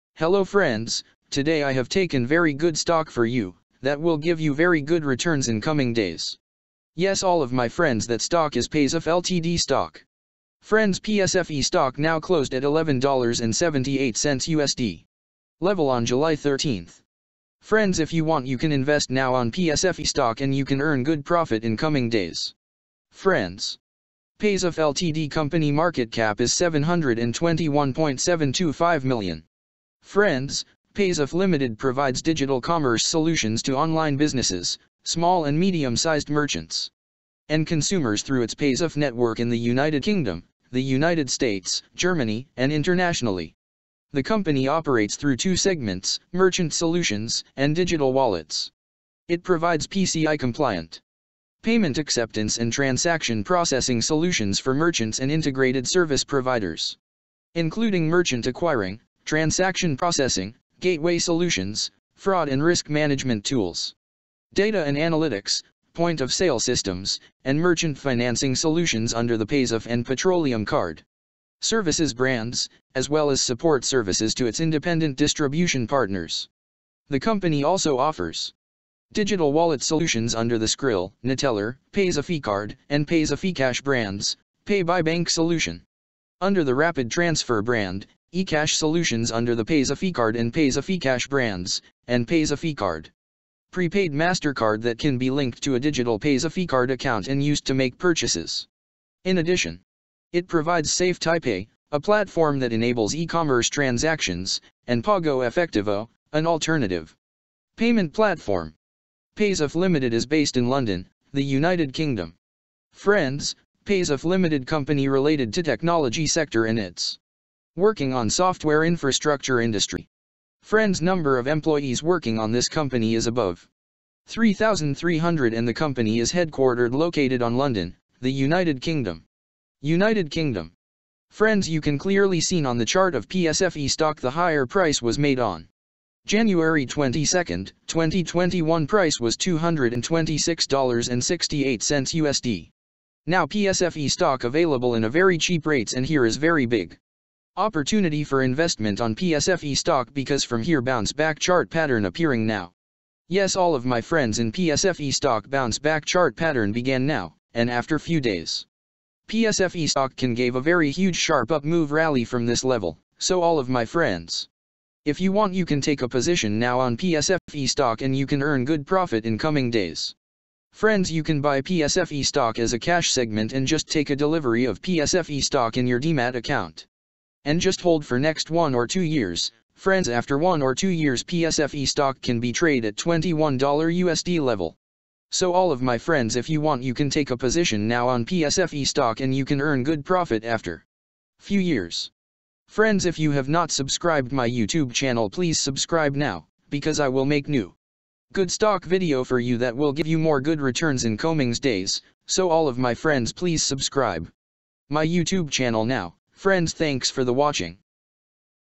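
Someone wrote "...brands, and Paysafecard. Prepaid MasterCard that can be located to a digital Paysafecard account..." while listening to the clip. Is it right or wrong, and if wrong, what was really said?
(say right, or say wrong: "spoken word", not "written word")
wrong: "linked", not "located".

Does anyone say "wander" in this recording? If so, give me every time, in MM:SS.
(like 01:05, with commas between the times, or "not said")
not said.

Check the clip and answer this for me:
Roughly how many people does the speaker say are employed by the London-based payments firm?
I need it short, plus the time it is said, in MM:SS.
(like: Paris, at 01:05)
above 3,300, at 02:03.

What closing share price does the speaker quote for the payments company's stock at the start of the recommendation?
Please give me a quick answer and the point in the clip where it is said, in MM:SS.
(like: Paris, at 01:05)
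$11.78, at 00:12.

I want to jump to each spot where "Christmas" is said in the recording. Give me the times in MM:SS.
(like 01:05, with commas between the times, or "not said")
not said.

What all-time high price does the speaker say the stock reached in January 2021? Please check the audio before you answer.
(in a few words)
$226.68.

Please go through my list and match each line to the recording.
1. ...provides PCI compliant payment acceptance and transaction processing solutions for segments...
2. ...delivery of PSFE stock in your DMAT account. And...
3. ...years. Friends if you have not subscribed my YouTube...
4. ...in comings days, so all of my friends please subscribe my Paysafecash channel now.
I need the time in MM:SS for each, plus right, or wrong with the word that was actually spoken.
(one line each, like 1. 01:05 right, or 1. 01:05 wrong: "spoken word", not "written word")
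1. 00:49 wrong: "merchants", not "segments"
2. 02:54 right
3. 03:11 right
4. 03:21 wrong: "YouTube", not "Paysafecash".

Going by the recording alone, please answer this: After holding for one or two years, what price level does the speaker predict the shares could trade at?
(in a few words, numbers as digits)
$21.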